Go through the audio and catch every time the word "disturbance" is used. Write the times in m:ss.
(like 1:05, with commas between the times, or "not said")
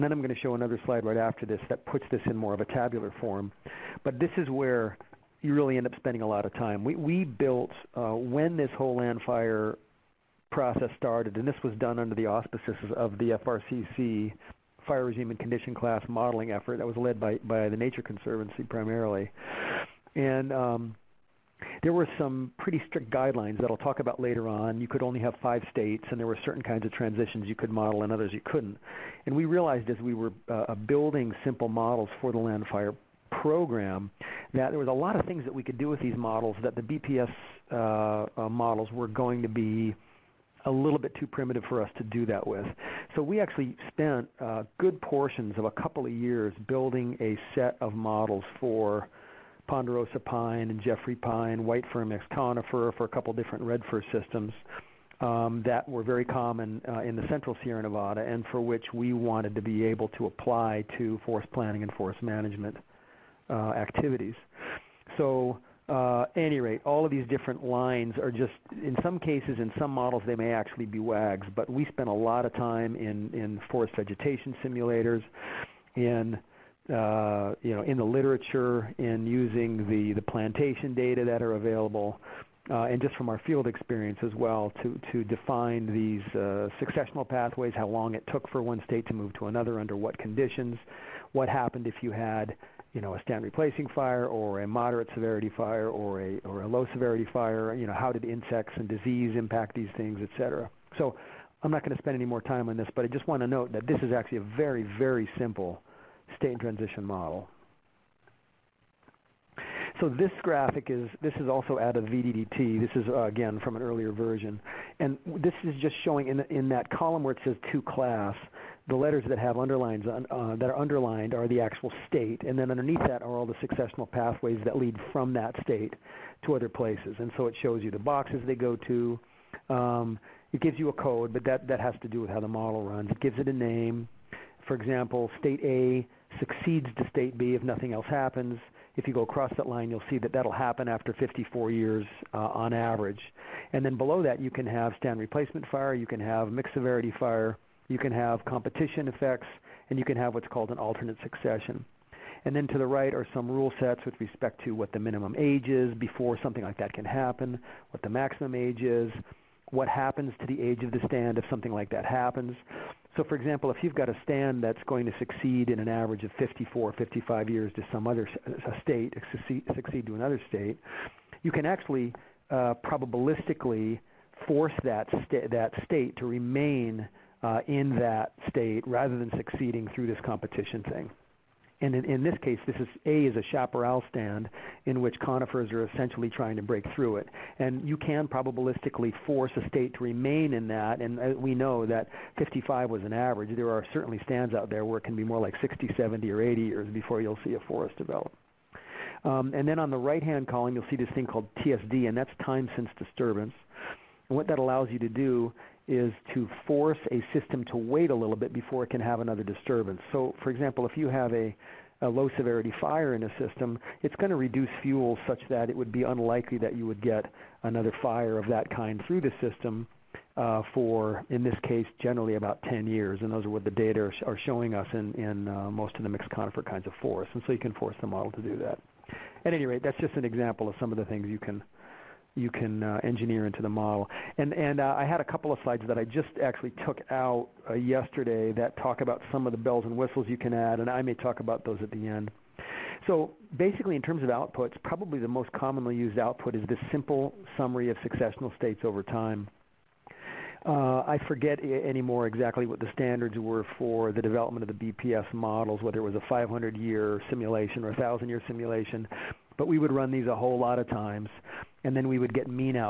3:22, 3:29.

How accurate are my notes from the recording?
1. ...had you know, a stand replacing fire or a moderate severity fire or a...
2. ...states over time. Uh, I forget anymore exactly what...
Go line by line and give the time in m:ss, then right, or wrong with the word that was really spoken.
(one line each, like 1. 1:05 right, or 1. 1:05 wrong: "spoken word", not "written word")
1. 1:32 right
2. 4:08 right.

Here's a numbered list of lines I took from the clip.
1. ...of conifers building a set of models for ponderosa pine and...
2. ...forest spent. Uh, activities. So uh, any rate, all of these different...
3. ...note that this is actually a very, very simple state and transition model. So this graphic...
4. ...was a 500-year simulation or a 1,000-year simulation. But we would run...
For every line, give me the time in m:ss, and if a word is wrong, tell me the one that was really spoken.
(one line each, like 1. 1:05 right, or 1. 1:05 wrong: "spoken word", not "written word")
1. 0:46 wrong: "years", not "conifers"
2. 1:01 wrong: "management", not "spent"
3. 1:43 right
4. 4:16 right.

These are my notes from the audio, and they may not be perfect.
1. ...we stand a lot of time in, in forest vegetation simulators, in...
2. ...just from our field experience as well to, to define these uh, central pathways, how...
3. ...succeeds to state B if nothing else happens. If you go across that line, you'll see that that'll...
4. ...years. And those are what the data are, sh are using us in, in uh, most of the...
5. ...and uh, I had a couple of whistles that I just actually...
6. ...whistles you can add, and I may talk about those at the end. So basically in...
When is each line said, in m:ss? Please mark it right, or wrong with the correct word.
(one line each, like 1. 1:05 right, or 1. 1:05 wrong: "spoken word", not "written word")
1. 1:11 wrong: "spend", not "stand"
2. 1:23 wrong: "successional", not "central"
3. 2:16 right
4. 3:42 wrong: "showing", not "using"
5. 3:54 wrong: "slides", not "whistles"
6. 3:59 right.